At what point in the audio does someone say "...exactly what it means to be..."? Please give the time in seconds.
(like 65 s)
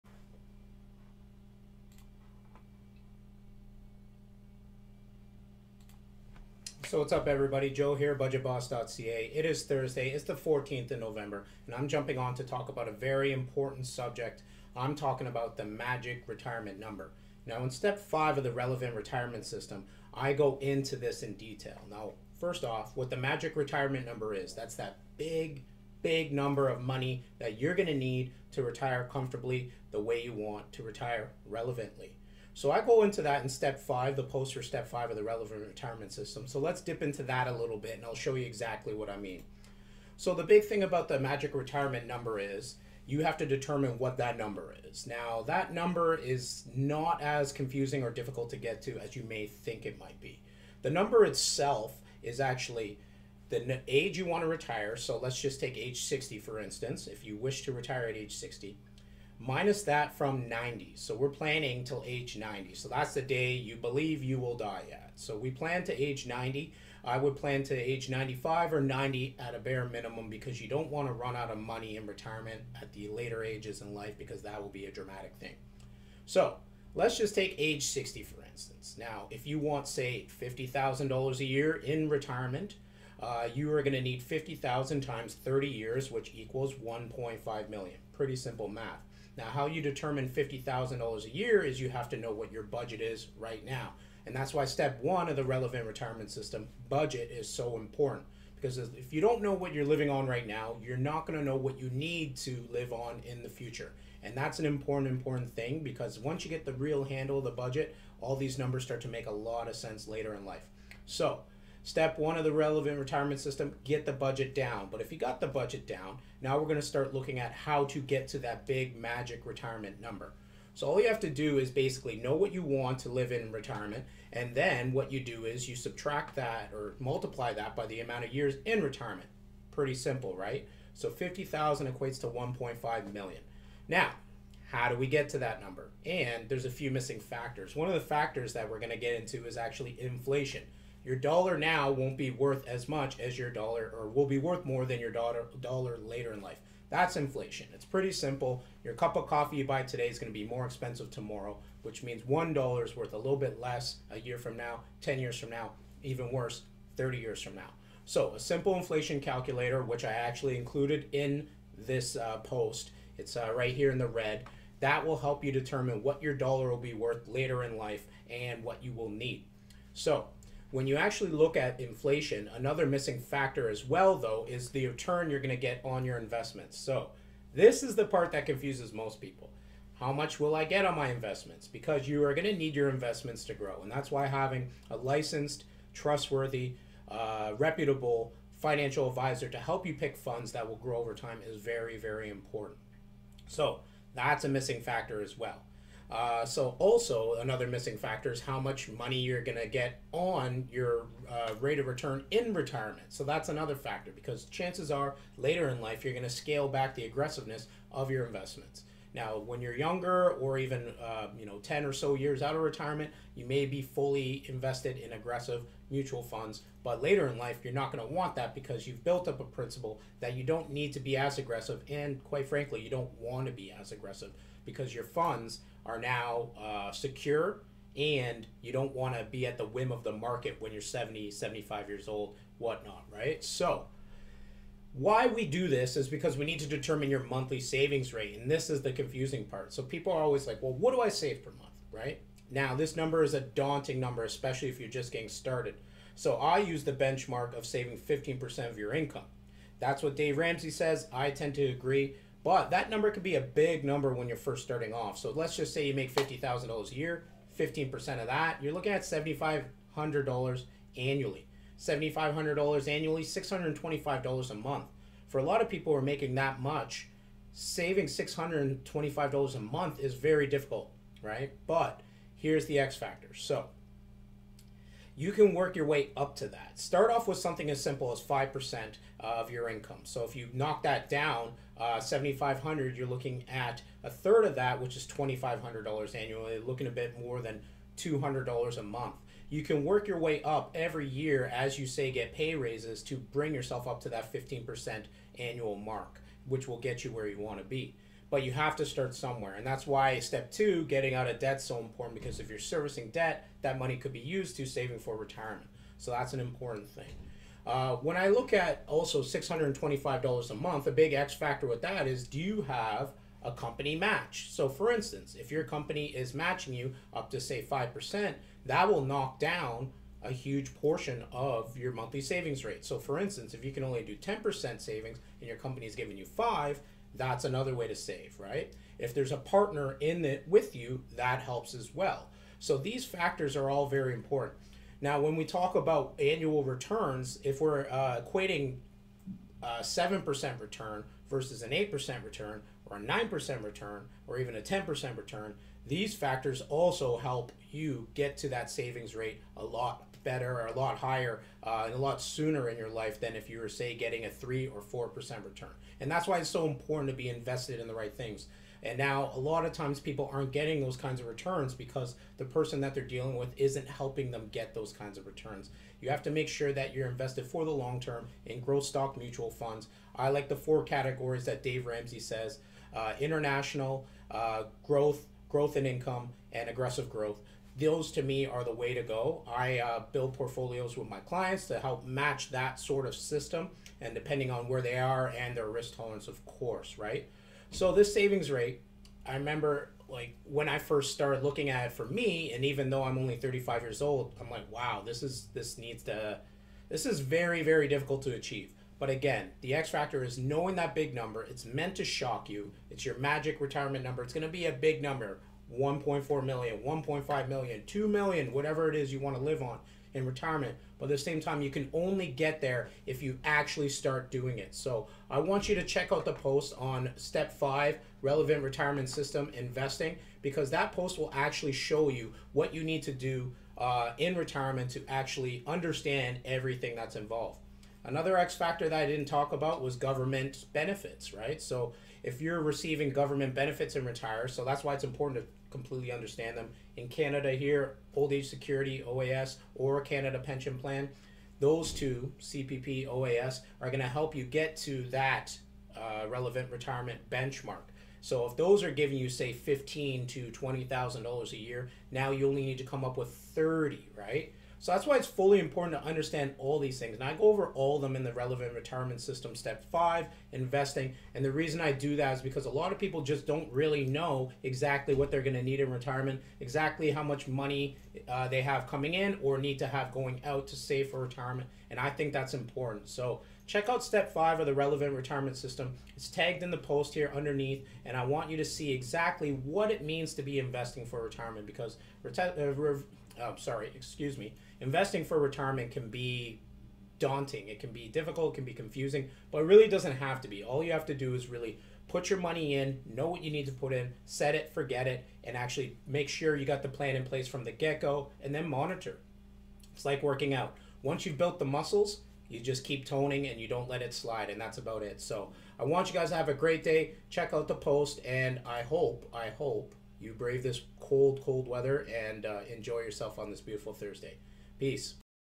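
478 s.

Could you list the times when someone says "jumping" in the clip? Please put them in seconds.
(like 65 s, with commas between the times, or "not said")
11 s.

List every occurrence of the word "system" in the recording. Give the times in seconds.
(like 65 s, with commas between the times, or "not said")
19 s, 36 s, 96 s, 113 s, 383 s, 419 s, 459 s, 475 s.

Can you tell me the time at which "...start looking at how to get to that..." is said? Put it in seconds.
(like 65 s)
116 s.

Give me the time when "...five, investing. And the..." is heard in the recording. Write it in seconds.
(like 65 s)
459 s.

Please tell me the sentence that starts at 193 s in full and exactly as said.
So, that's a missing factor as well.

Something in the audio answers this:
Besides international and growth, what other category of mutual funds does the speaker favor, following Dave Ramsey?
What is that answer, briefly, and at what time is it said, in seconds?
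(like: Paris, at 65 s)
Aggressive growth, at 376 s.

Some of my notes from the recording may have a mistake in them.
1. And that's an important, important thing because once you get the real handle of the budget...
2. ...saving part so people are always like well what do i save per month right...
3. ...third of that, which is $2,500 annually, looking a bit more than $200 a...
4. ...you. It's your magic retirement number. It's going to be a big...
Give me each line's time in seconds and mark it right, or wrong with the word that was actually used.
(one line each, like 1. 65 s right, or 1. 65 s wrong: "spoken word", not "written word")
1. 104 s right
2. 238 s wrong: "confusing", not "saving"
3. 284 s right
4. 402 s right.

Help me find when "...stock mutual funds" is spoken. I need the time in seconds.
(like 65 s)
368 s.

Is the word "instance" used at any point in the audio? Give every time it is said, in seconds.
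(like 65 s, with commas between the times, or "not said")
56 s, 78 s, 314 s, 323 s.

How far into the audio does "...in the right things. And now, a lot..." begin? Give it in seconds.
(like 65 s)
357 s.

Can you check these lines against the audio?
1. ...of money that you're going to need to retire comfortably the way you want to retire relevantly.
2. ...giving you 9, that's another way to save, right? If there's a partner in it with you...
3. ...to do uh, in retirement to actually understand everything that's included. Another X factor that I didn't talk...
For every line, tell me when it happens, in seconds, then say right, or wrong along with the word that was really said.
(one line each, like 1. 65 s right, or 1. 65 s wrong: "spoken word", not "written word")
1. 26 s right
2. 325 s wrong: "5", not "9"
3. 423 s wrong: "involved", not "included".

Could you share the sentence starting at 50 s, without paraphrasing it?
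The number itself is actually the age you want to retire.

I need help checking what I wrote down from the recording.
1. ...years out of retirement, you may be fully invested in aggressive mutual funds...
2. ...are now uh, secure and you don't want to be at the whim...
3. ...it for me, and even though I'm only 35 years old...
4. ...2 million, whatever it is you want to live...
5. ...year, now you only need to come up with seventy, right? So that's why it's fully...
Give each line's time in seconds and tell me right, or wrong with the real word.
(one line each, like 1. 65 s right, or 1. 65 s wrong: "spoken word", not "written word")
1. 212 s right
2. 225 s right
3. 391 s right
4. 407 s right
5. 451 s wrong: "thirty", not "seventy".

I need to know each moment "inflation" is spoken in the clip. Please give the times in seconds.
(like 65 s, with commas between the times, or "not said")
139 s, 147 s, 158 s, 171 s.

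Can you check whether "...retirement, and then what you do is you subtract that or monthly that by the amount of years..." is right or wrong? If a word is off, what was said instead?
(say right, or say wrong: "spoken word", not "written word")
wrong: "multiply", not "monthly".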